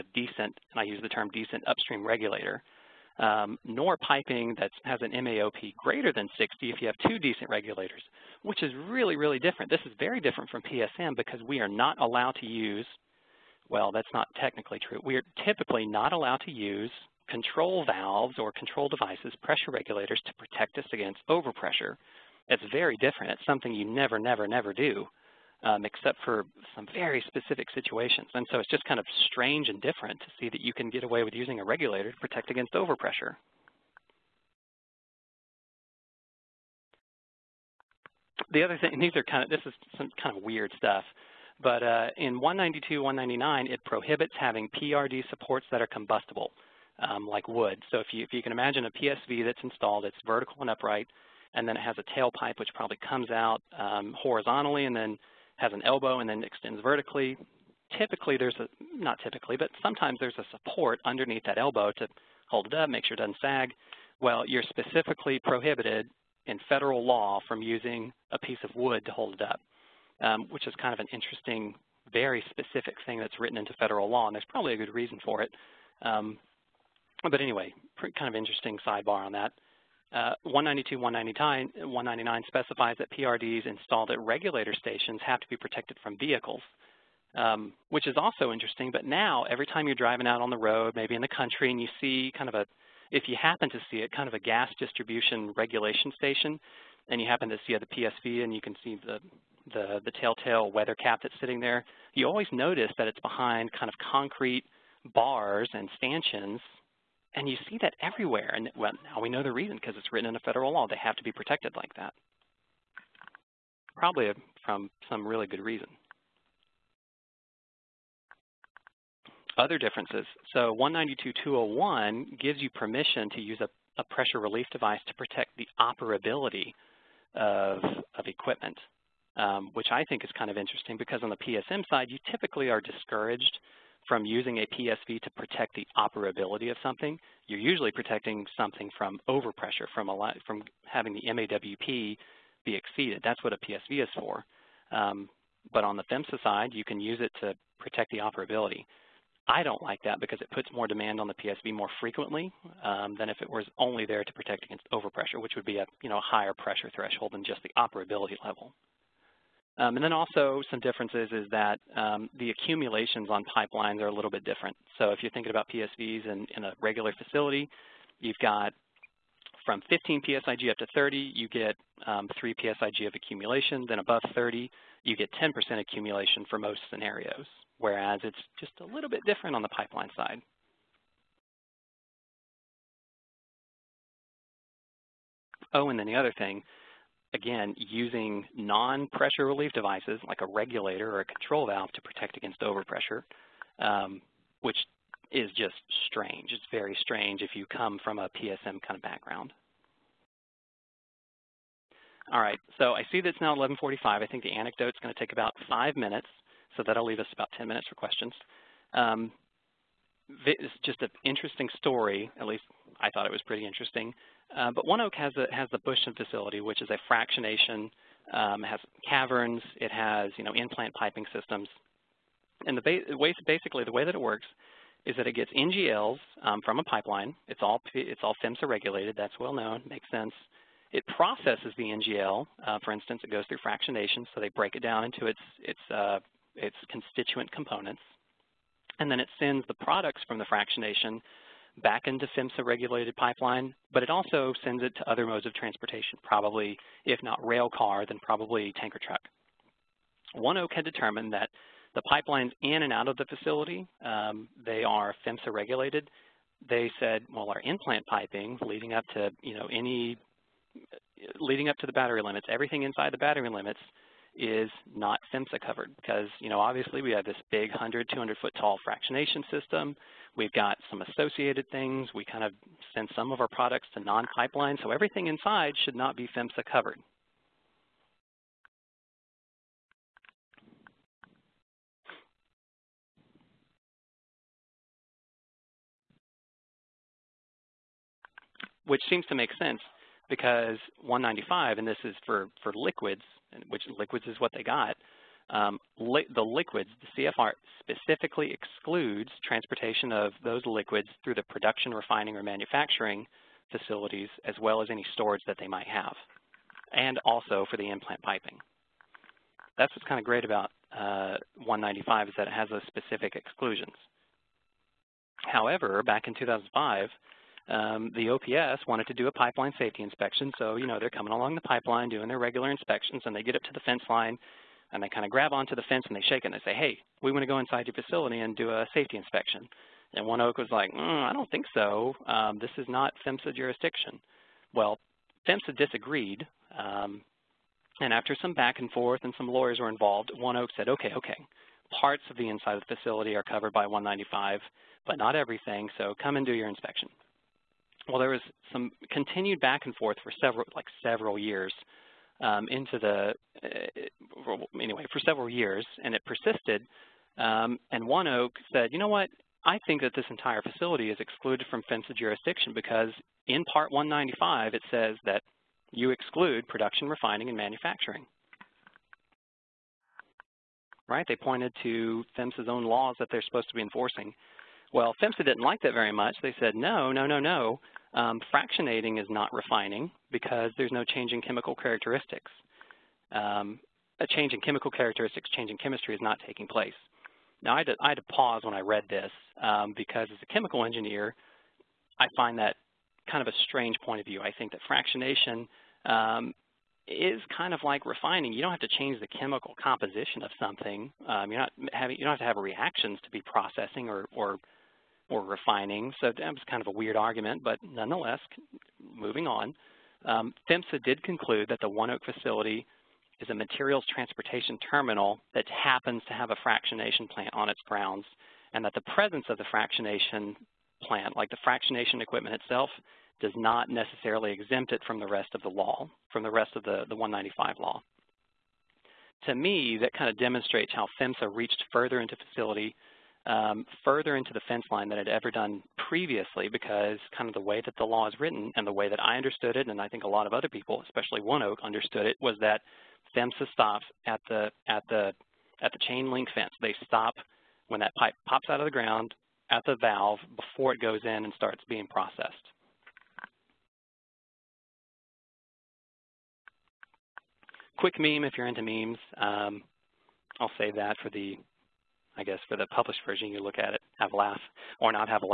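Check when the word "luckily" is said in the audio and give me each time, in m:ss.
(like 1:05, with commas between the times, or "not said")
not said.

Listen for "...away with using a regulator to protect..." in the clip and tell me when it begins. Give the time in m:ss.
0:31.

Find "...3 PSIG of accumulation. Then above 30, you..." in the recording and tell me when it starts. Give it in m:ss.
2:52.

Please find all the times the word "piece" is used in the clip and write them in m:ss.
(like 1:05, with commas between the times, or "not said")
1:08.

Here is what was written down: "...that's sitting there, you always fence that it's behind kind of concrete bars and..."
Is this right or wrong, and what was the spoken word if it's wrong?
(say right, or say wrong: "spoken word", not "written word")
wrong: "notice", not "fence".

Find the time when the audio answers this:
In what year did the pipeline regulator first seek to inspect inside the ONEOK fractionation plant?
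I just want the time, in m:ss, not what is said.
5:16.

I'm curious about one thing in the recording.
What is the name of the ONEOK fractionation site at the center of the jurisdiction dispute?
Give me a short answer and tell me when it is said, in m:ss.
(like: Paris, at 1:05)
Bushton, at 3:35.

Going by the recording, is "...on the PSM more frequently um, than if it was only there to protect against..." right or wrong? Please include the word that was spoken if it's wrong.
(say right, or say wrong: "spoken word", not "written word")
wrong: "PSV", not "PSM".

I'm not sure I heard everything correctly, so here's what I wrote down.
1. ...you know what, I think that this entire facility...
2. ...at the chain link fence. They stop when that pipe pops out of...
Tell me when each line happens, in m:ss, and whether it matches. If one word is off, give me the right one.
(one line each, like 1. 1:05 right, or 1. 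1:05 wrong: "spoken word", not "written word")
1. 5:58 right
2. 7:25 right.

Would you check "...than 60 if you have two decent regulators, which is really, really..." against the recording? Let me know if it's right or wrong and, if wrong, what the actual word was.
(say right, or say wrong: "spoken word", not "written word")
right.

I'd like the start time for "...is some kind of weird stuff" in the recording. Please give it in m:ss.
0:39.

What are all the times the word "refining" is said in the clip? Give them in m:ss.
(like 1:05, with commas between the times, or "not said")
5:01, 6:07, 6:19, 6:38, 6:45.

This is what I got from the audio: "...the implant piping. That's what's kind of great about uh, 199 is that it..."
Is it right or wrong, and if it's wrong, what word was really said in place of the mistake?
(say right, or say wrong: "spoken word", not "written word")
wrong: "195", not "199".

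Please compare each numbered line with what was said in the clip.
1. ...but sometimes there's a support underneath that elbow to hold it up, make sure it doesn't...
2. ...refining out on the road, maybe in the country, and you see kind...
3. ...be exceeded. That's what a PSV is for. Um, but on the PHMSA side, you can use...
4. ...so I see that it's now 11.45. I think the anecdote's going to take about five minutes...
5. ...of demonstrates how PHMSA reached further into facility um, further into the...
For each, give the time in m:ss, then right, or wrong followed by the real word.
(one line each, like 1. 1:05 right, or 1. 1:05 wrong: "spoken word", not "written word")
1. 0:59 right
2. 1:29 wrong: "driving", not "refining"
3. 2:22 right
4. 3:22 right
5. 7:10 right.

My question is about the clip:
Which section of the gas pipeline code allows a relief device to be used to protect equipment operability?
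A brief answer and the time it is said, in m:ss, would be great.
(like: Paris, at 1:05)
192.201, at 2:00.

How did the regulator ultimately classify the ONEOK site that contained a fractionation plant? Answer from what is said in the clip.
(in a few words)
materials transportation terminal.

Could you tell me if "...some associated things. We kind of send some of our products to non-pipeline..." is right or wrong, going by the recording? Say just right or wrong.
right.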